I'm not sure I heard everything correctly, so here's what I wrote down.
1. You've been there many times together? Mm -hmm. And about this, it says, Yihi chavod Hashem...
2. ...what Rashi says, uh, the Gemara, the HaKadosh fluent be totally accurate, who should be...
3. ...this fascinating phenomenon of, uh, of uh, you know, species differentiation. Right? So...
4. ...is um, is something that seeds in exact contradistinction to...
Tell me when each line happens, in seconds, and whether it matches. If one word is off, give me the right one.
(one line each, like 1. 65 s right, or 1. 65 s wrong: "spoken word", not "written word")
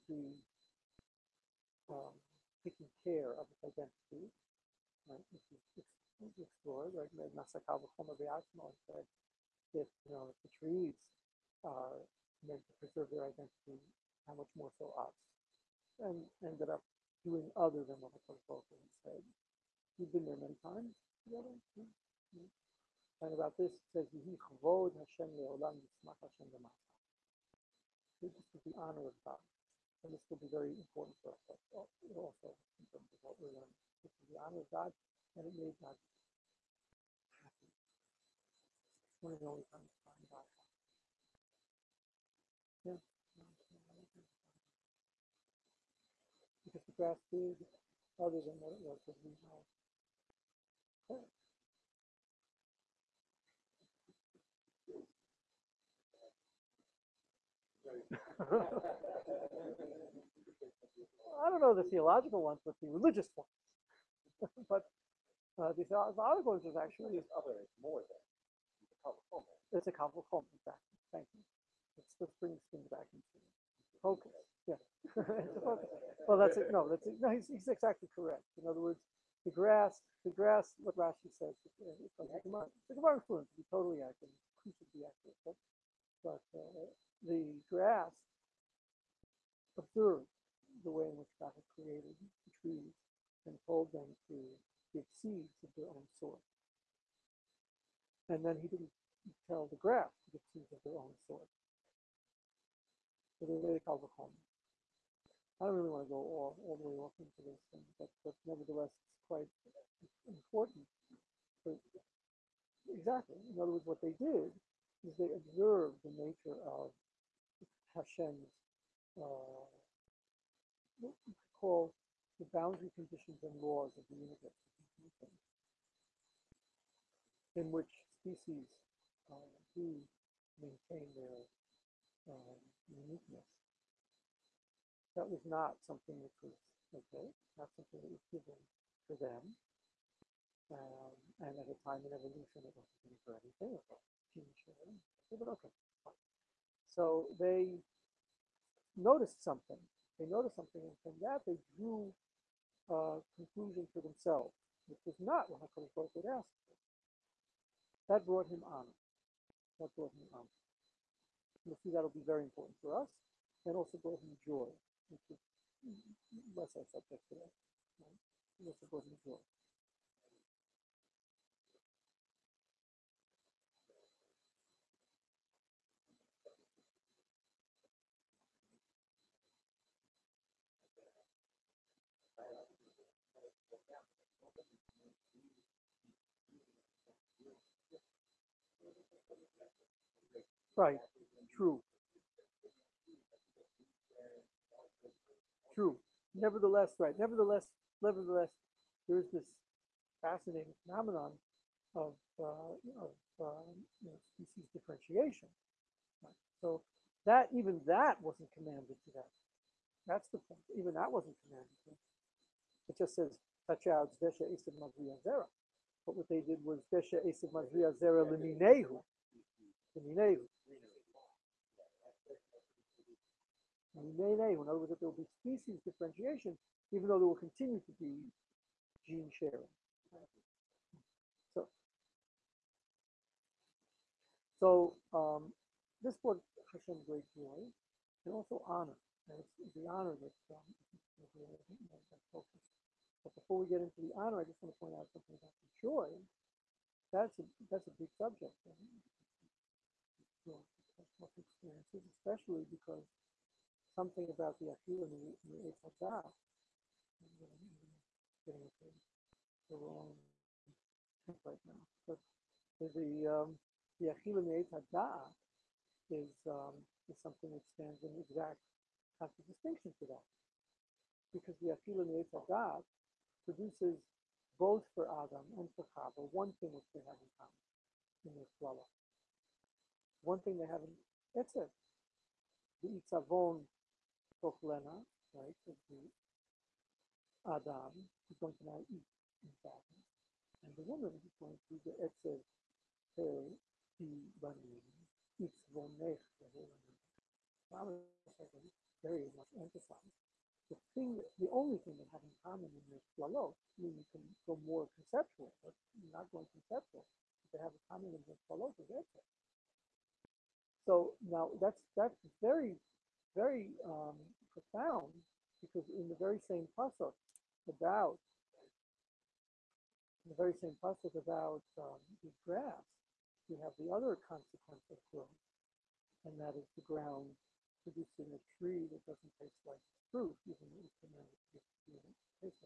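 1. 19 s right
2. 80 s wrong: "Gemara", not "HaKadosh"
3. 199 s right
4. 266 s wrong: "stands", not "seeds".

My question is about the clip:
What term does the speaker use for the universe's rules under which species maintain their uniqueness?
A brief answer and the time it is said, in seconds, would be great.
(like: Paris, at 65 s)
boundary conditions, at 122 s.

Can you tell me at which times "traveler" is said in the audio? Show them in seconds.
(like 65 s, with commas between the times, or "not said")
not said.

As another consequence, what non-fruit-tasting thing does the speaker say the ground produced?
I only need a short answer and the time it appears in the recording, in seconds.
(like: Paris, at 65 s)
a tree, at 328 s.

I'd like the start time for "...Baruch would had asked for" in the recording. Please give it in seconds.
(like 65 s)
155 s.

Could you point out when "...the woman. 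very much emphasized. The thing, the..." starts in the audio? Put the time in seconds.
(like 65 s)
296 s.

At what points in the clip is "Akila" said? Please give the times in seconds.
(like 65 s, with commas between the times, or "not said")
254 s, 264 s, 271 s.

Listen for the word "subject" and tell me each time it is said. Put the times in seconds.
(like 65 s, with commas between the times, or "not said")
166 s, 248 s.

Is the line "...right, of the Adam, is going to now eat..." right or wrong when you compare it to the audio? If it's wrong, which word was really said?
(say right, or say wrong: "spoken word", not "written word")
right.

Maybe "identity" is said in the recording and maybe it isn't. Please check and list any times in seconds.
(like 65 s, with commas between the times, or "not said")
3 s, 13 s.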